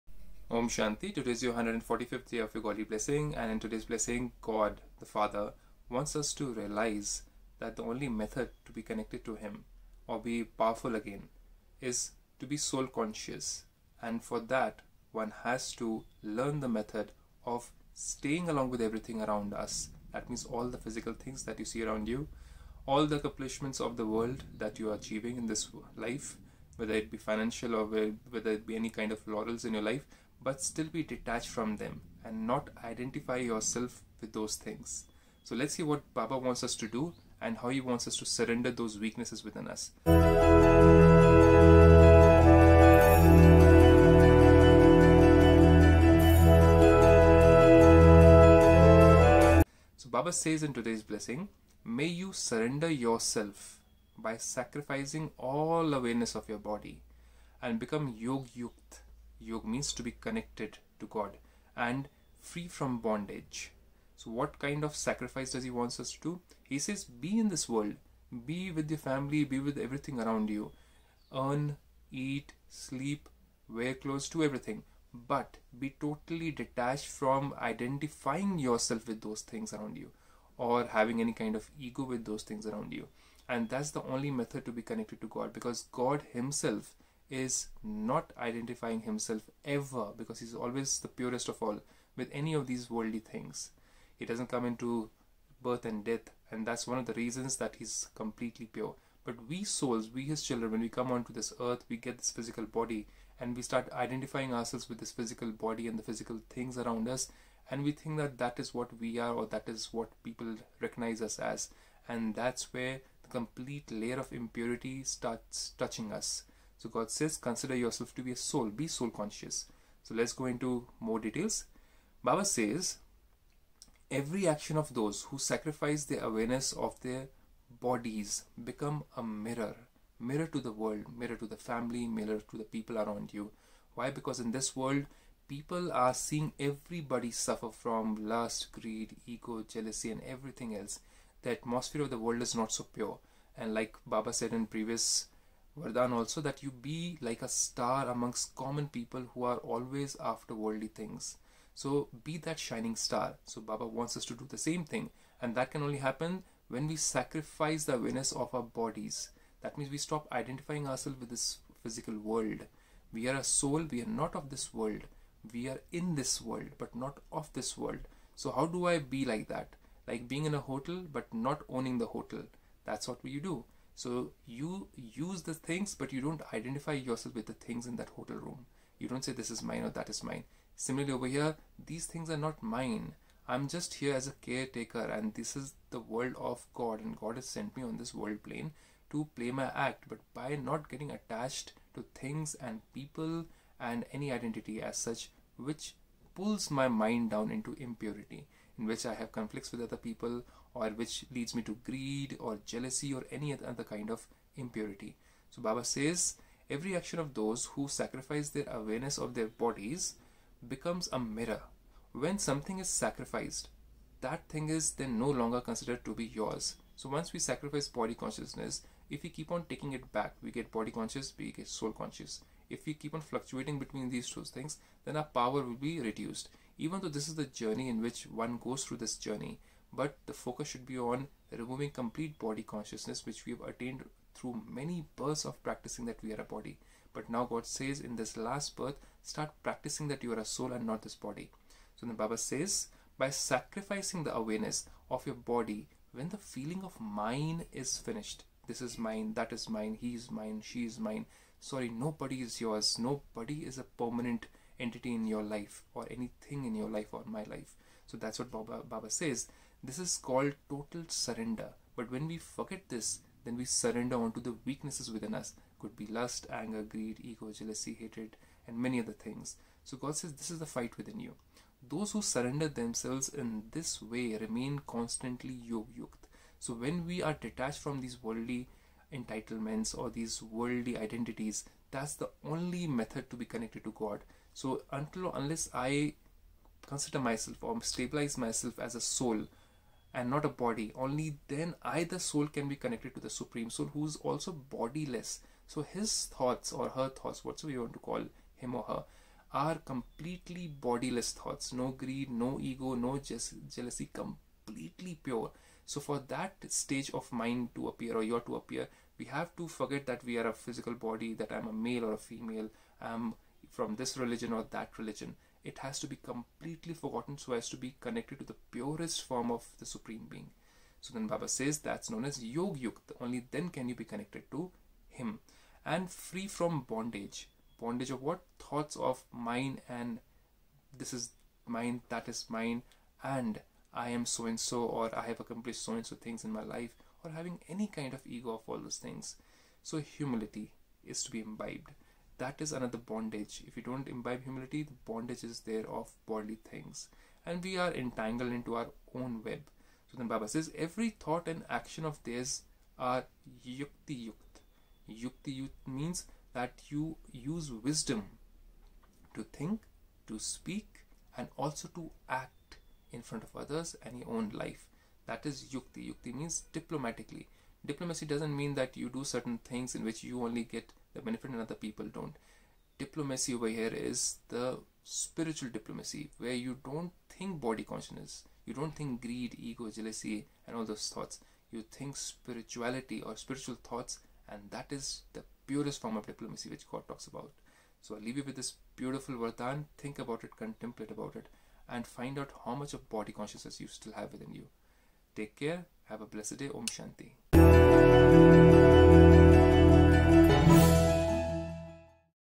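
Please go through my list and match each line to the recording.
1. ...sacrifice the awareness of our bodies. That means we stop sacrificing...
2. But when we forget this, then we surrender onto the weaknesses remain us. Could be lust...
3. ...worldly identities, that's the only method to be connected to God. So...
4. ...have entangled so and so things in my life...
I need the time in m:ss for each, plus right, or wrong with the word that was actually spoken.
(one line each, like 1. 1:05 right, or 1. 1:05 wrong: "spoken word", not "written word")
1. 2:36 wrong: "identifying", not "sacrificing"
2. 4:21 wrong: "within", not "remain"
3. 4:40 right
4. 5:35 wrong: "accomplished", not "entangled".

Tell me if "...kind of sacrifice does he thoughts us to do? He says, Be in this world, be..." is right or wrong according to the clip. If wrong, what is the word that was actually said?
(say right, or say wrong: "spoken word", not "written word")
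wrong: "wants", not "thoughts".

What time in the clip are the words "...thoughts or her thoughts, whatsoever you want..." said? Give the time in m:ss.
4:56.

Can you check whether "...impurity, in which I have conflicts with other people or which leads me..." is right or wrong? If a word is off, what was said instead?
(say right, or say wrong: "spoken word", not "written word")
right.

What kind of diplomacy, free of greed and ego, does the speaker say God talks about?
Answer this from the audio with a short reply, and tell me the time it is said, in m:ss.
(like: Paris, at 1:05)
Spiritual diplomacy, at 6:15.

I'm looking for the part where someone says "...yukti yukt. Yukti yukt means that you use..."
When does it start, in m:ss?
5:53.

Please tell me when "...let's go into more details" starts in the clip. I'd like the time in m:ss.
2:00.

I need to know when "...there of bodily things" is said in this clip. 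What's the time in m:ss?
5:45.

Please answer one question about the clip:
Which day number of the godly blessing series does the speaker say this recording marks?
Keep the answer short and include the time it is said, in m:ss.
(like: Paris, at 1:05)
145th, at 0:01.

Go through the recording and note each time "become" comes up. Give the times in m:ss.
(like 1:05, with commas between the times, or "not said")
0:57, 2:08, 3:30.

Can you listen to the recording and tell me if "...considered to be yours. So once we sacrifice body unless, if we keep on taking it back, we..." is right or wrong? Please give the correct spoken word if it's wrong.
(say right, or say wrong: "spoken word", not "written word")
wrong: "consciousness", not "unless".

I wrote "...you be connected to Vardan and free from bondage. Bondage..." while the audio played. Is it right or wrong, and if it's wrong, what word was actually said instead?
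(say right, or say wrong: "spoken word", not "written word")
wrong: "Him", not "Vardan".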